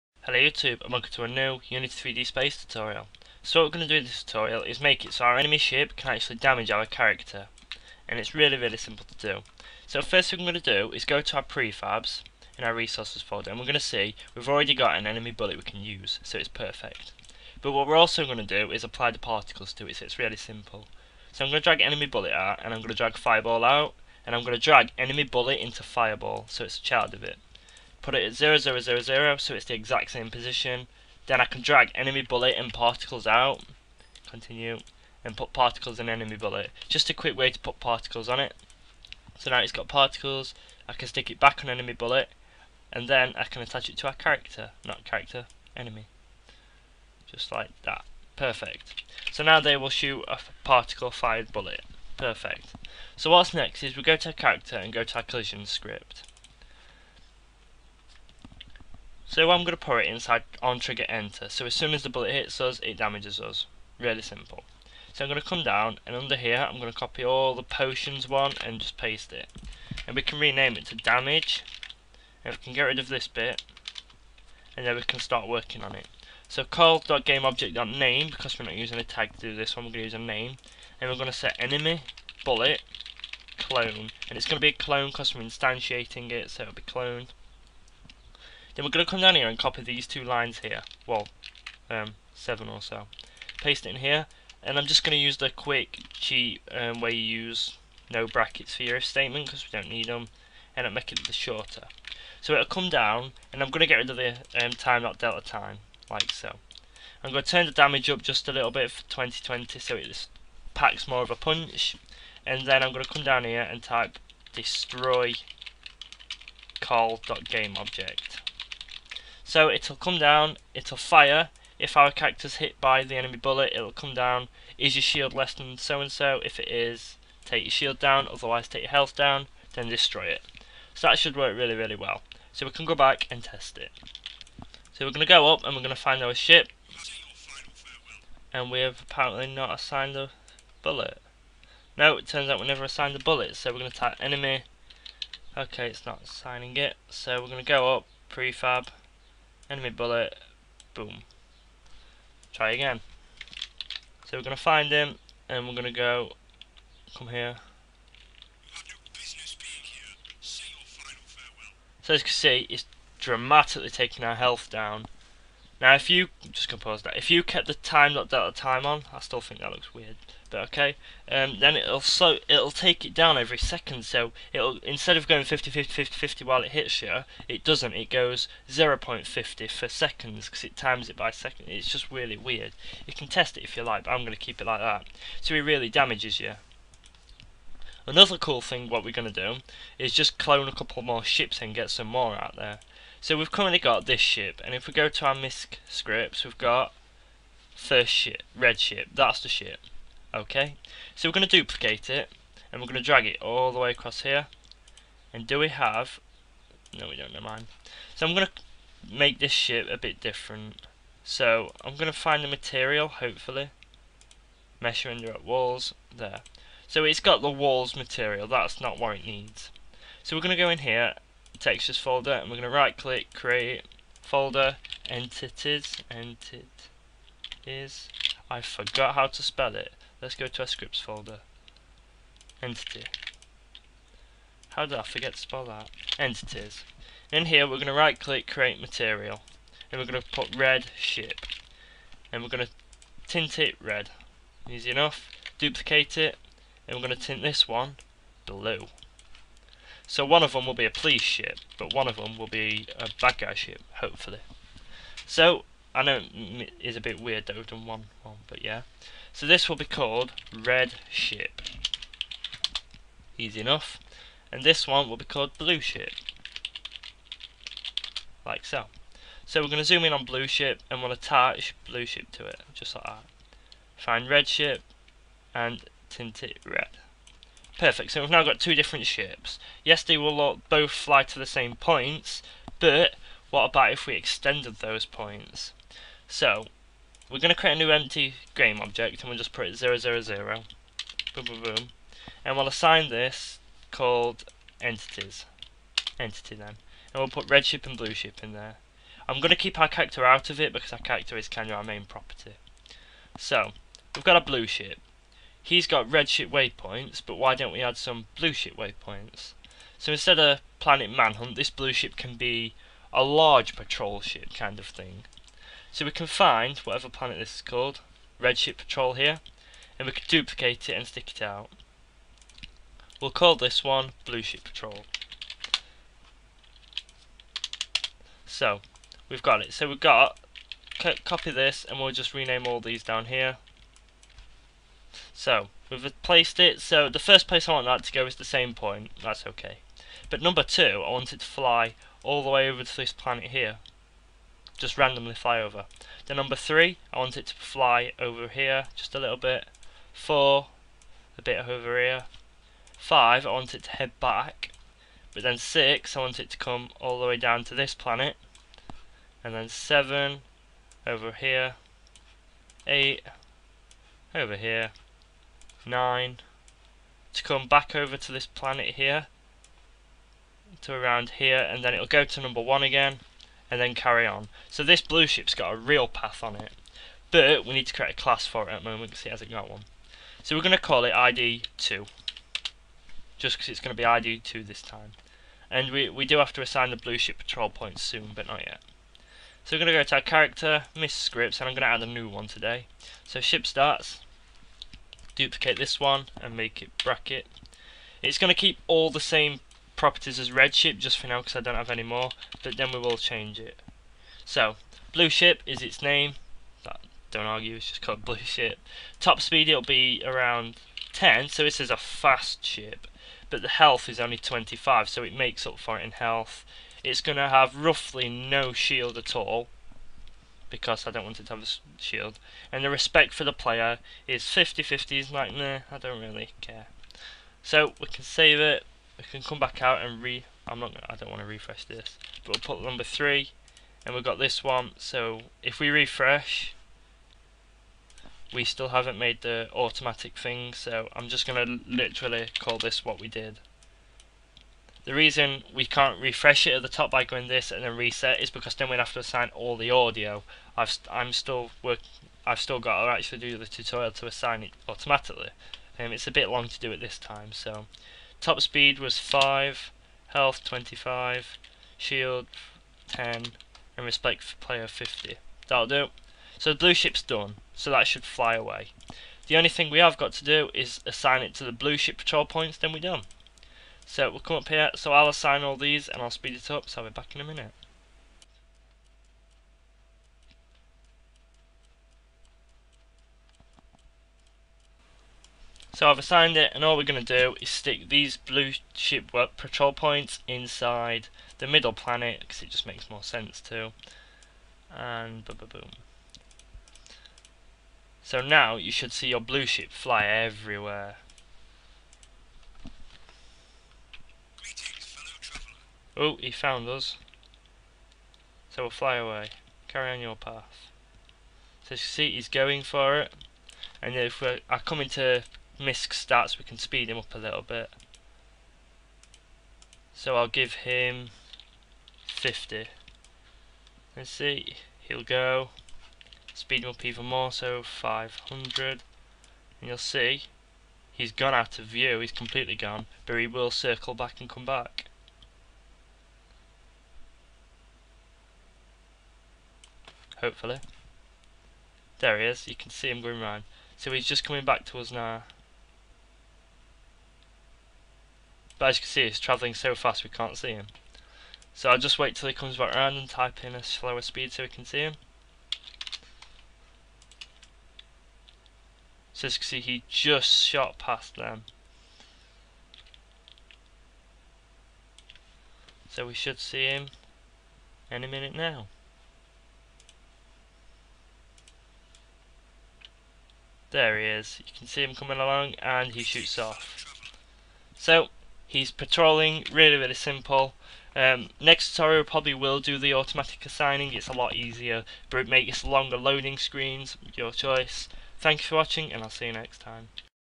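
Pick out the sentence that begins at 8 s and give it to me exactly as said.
And it's really really simple to do.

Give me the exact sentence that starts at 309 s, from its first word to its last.
So instead of Planet Manhunt, this blue ship can be a large patrol ship kind of thing.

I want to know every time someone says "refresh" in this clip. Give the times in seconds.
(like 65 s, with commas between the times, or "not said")
431 s, 435 s, 446 s.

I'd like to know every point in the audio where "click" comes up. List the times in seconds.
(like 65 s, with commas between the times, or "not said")
222 s, 238 s.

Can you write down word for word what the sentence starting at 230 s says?
Let's go to our scripts folder.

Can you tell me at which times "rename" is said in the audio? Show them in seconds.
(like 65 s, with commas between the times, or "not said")
70 s, 332 s.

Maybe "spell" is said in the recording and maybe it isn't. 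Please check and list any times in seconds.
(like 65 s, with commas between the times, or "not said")
229 s, 235 s.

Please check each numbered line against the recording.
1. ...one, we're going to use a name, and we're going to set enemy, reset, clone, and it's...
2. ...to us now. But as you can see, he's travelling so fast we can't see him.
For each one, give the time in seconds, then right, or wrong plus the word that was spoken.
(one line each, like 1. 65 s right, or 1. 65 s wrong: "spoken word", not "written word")
1. 79 s wrong: "bullet", not "reset"
2. 544 s right.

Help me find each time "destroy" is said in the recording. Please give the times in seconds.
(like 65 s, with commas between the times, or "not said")
114 s, 129 s.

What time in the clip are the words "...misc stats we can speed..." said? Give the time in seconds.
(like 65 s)
515 s.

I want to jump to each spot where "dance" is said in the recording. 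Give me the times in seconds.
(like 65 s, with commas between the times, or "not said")
not said.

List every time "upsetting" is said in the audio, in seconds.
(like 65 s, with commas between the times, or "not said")
not said.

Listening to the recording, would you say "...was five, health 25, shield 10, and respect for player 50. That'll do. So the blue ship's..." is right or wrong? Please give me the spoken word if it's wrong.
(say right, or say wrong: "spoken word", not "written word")
right.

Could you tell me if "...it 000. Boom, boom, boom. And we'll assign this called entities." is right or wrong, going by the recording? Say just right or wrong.
right.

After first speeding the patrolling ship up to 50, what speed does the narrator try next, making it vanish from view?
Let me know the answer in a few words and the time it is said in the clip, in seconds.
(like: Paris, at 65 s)
500, at 527 s.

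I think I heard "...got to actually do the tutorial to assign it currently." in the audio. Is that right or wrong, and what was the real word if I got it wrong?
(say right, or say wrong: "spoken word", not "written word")
wrong: "automatically", not "currently".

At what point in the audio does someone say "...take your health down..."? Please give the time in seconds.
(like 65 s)
128 s.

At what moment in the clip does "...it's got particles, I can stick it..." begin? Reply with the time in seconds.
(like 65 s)
39 s.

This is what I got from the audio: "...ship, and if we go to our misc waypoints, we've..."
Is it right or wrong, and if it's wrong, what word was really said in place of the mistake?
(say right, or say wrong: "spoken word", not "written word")
wrong: "scripts", not "waypoints".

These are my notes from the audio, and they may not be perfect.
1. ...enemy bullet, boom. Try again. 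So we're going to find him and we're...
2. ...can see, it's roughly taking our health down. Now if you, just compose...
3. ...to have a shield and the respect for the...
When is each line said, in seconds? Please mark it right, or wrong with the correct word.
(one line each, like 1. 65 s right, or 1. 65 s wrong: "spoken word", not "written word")
1. 149 s right
2. 162 s wrong: "dramatically", not "roughly"
3. 421 s right.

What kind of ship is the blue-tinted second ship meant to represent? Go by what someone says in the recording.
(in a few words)
police ship.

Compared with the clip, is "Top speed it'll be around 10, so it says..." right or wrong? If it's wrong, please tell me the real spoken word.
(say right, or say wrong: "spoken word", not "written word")
right.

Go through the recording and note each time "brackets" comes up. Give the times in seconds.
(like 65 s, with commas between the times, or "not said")
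98 s, 397 s.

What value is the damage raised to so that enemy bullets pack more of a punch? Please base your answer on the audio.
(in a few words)
20.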